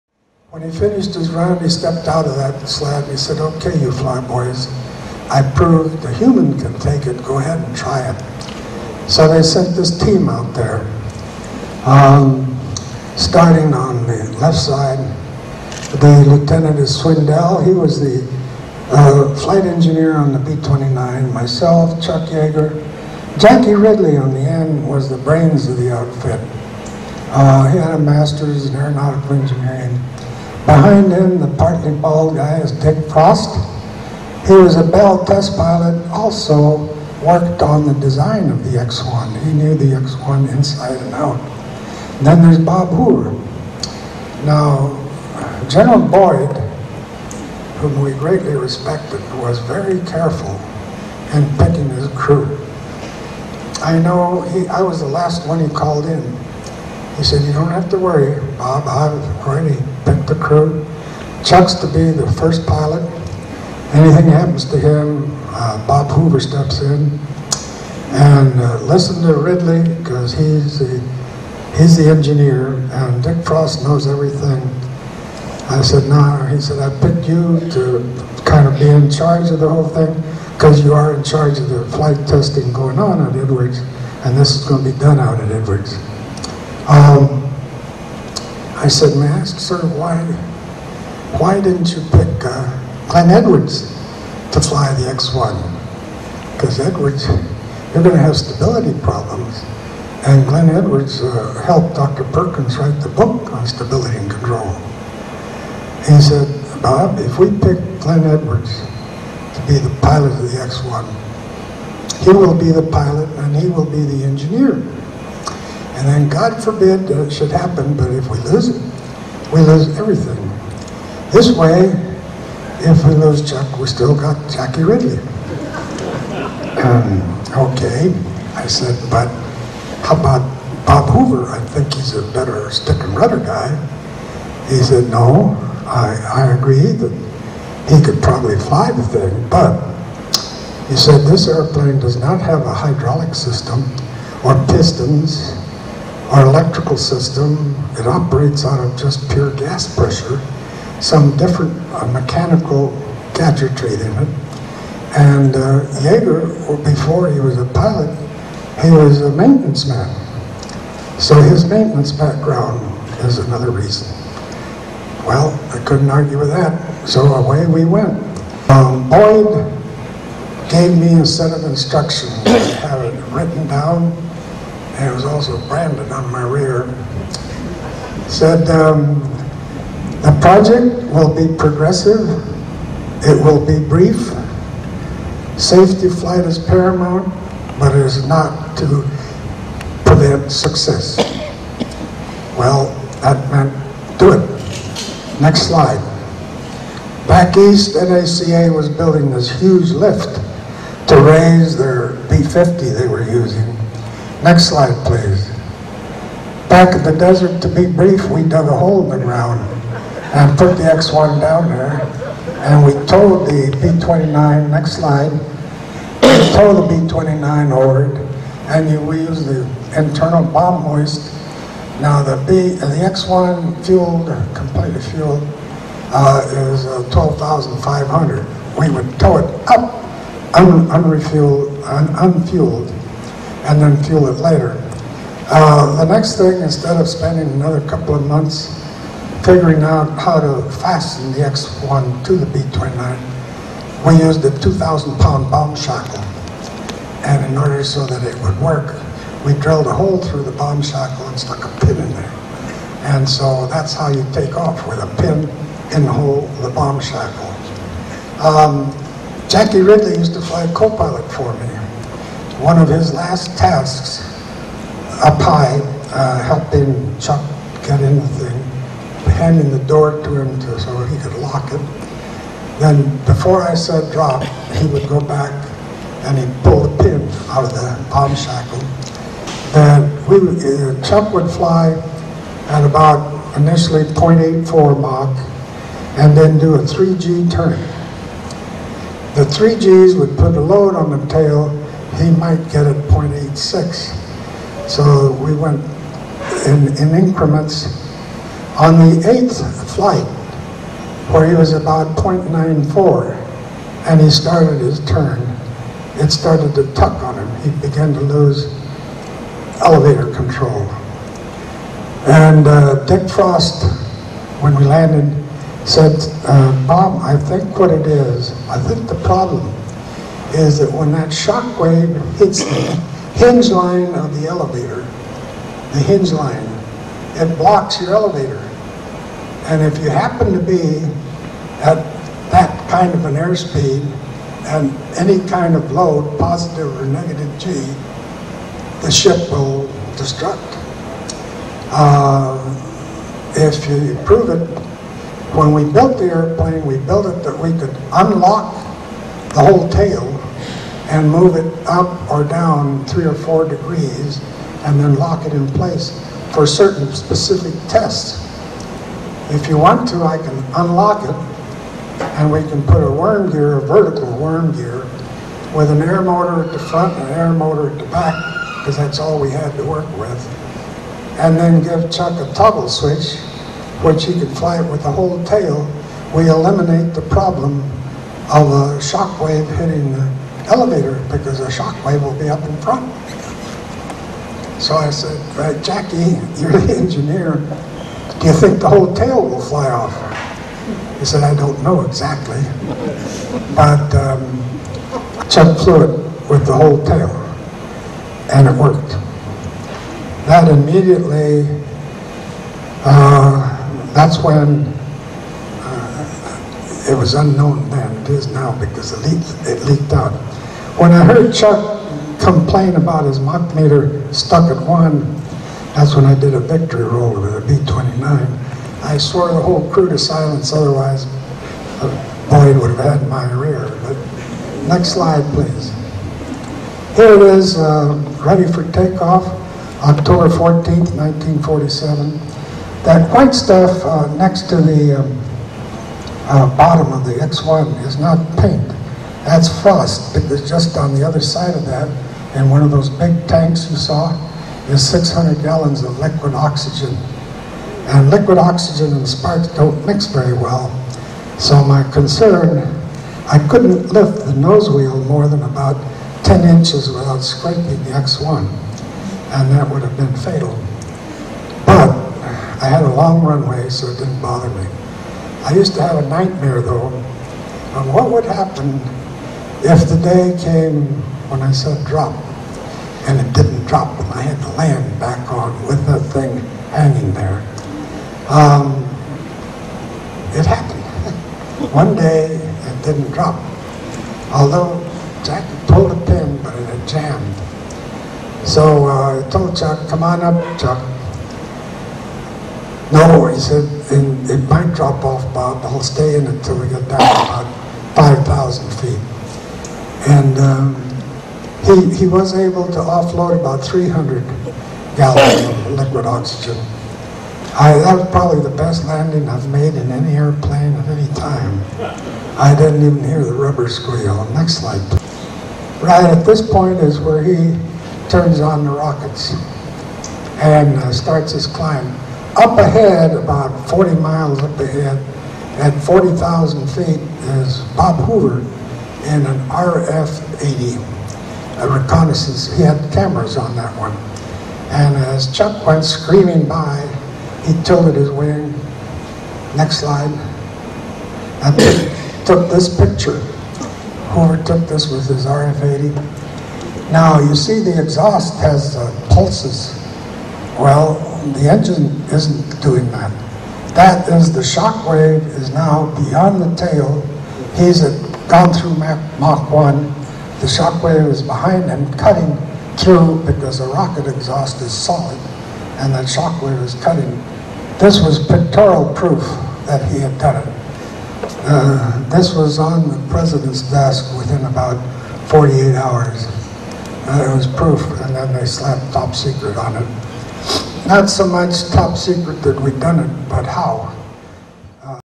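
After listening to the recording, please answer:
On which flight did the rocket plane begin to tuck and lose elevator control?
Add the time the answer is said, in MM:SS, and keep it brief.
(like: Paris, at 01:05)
eighth flight, at 04:59.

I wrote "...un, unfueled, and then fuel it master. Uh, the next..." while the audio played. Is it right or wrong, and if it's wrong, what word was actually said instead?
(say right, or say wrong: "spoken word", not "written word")
wrong: "later", not "master".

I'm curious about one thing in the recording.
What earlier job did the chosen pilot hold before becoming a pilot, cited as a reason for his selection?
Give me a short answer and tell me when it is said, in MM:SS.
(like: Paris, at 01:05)
maintenance man, at 02:39.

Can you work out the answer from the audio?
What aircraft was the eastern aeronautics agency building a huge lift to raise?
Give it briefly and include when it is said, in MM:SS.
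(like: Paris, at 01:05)
B-50, at 03:22.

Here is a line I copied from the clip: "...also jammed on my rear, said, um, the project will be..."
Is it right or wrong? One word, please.
wrong.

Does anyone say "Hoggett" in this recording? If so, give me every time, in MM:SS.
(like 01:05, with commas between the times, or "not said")
00:58.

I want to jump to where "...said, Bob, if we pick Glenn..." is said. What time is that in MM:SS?
01:46.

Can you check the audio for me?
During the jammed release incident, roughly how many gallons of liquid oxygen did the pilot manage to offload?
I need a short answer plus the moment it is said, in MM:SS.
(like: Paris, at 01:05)
300, at 08:23.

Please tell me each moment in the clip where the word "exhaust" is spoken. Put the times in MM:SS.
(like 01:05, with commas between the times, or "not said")
09:08, 09:24.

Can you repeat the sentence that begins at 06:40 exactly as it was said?
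That immediately, uh, that's when uh, it was unknown then, it is now because it leaked, it leaked out.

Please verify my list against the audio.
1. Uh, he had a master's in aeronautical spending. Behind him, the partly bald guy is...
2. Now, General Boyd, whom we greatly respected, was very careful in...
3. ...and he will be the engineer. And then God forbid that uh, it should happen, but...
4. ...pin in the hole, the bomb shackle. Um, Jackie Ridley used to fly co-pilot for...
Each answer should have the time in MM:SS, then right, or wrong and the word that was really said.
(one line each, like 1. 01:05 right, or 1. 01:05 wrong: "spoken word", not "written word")
1. 00:27 wrong: "engineering", not "spending"
2. 00:44 right
3. 01:53 right
4. 04:15 right.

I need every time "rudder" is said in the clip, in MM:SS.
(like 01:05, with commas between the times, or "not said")
02:13.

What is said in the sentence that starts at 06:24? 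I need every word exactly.
So I said, uh, Jackie, you're the engineer.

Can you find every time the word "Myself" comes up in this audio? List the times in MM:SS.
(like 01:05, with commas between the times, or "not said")
00:21.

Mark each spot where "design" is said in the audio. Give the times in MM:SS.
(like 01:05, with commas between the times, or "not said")
00:37.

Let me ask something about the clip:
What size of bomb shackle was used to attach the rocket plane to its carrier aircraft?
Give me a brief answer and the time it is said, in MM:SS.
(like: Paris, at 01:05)
2,000 pound, at 04:04.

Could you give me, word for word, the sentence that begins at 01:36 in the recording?
Because Edwards, you're going to have stability problems.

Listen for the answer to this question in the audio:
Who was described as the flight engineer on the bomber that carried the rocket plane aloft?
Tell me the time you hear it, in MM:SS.
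00:17.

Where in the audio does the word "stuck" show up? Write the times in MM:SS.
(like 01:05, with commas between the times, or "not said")
04:11, 06:54.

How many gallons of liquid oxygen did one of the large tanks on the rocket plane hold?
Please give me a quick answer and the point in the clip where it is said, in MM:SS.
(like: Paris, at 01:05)
600, at 07:25.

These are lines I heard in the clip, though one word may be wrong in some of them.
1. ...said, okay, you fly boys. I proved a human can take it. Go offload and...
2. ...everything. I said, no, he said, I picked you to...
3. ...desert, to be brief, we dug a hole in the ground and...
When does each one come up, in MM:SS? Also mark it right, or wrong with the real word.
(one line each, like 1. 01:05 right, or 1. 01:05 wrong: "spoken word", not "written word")
1. 00:03 wrong: "ahead", not "offload"
2. 01:14 right
3. 03:27 right.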